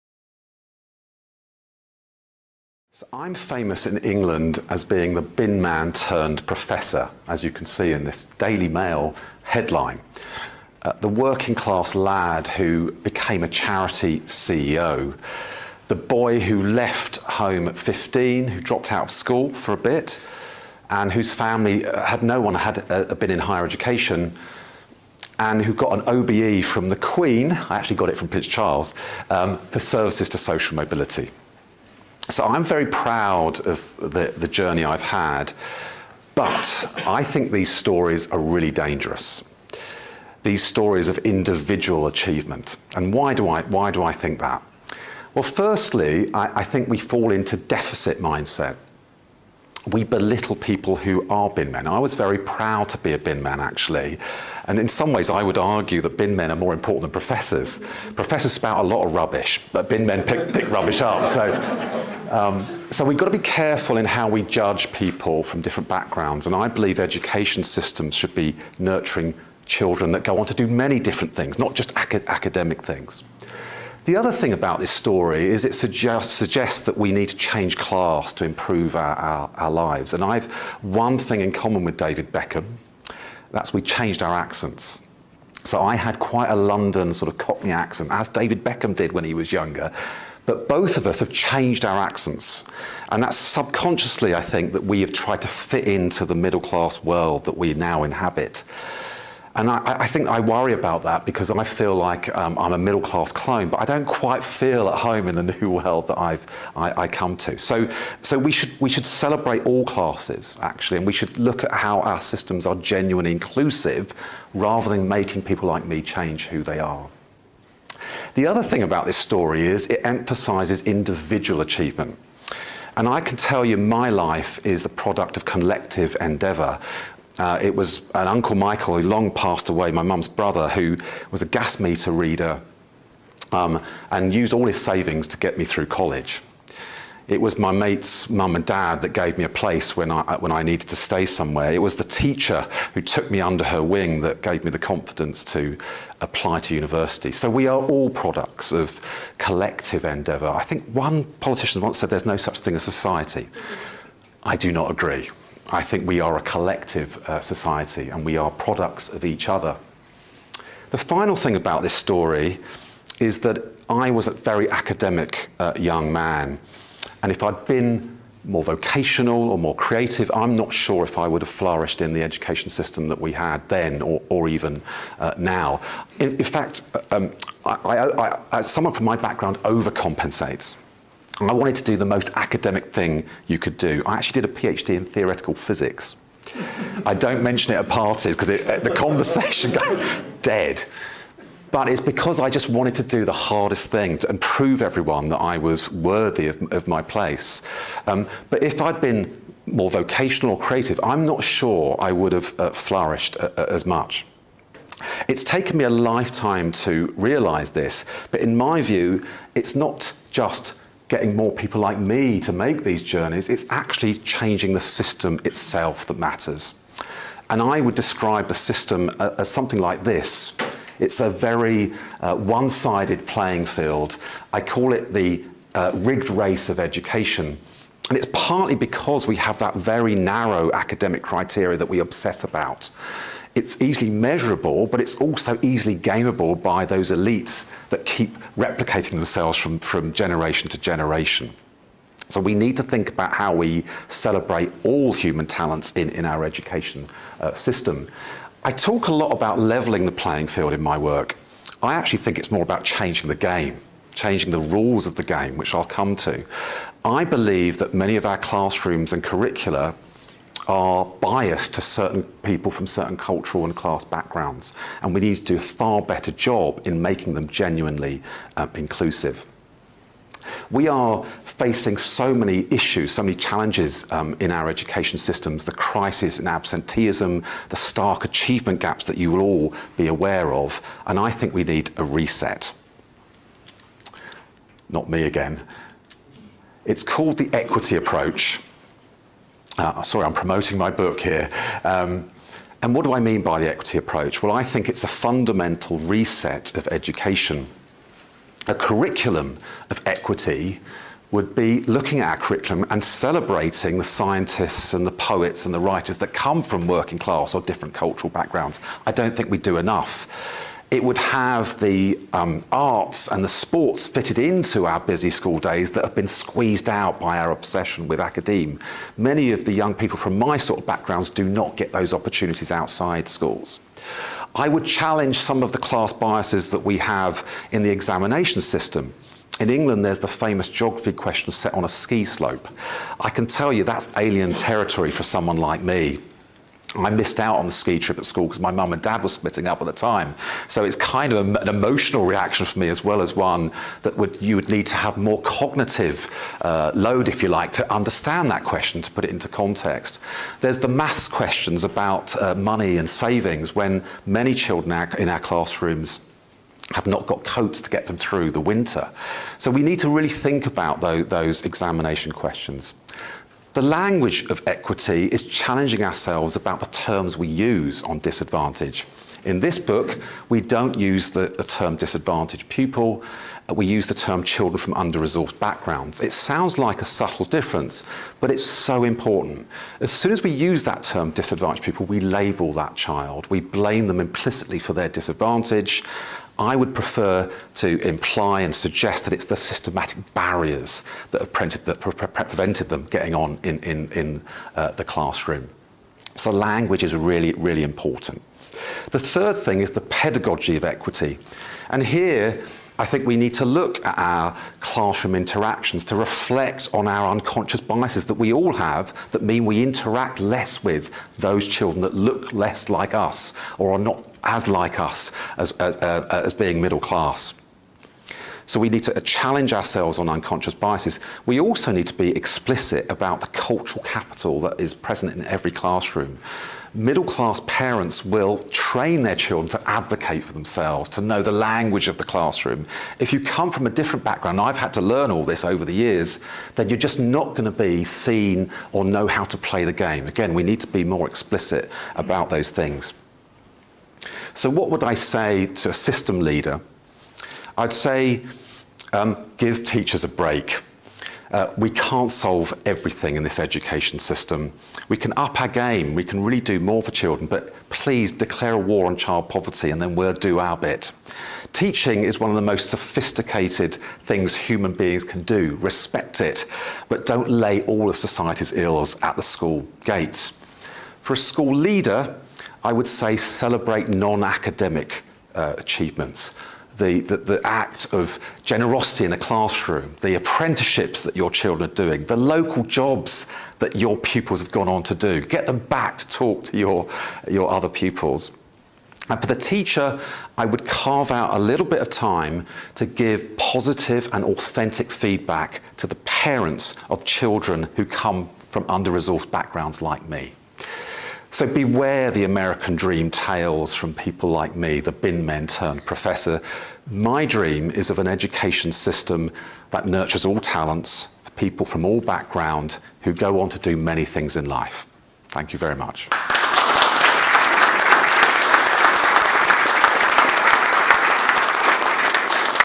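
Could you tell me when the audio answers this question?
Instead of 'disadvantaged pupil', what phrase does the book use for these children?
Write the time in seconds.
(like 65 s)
374 s.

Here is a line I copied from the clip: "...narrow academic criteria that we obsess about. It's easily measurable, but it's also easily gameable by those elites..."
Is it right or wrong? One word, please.
right.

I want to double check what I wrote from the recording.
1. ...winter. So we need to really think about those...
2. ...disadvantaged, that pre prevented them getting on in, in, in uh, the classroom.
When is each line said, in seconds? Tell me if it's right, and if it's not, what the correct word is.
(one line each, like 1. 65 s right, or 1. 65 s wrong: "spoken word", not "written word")
1. 358 s right
2. 391 s wrong: "prevented", not "disadvantaged".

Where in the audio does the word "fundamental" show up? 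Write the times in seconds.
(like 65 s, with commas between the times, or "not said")
295 s.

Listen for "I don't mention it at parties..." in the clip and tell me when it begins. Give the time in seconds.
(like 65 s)
187 s.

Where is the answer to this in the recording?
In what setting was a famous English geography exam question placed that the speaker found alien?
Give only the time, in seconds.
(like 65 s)
331 s.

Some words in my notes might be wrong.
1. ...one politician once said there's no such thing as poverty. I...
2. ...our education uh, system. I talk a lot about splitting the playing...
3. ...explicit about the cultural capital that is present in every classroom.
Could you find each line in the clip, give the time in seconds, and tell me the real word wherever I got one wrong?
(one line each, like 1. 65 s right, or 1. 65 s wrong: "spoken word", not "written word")
1. 150 s wrong: "society", not "poverty"
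2. 246 s wrong: "leveling", not "splitting"
3. 422 s right.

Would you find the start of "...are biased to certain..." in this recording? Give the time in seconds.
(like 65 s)
260 s.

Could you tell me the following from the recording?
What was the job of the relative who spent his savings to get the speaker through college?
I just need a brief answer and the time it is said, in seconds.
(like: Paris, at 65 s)
Gas meter reader, at 131 s.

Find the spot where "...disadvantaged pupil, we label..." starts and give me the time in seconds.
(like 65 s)
381 s.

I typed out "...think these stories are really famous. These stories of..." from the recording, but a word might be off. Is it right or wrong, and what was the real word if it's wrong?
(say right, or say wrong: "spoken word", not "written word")
wrong: "dangerous", not "famous".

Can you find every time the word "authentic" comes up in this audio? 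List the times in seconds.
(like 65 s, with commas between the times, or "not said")
494 s.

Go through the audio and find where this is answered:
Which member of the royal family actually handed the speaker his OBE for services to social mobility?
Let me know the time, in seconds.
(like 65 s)
28 s.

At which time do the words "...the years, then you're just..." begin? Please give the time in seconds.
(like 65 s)
435 s.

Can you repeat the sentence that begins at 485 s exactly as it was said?
Get them back to talk to your, your other pupils.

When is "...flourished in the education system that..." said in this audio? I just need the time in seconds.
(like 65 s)
171 s.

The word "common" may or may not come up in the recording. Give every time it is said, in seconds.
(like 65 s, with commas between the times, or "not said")
81 s.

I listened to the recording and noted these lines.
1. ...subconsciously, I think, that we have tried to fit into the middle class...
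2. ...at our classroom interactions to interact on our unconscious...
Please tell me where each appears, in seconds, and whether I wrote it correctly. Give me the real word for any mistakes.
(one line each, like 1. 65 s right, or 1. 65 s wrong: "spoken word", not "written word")
1. 93 s right
2. 404 s wrong: "reflect", not "interact".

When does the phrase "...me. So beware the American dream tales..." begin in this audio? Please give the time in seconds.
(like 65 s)
500 s.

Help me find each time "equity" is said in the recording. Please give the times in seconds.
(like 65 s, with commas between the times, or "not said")
287 s, 293 s, 300 s, 364 s, 400 s.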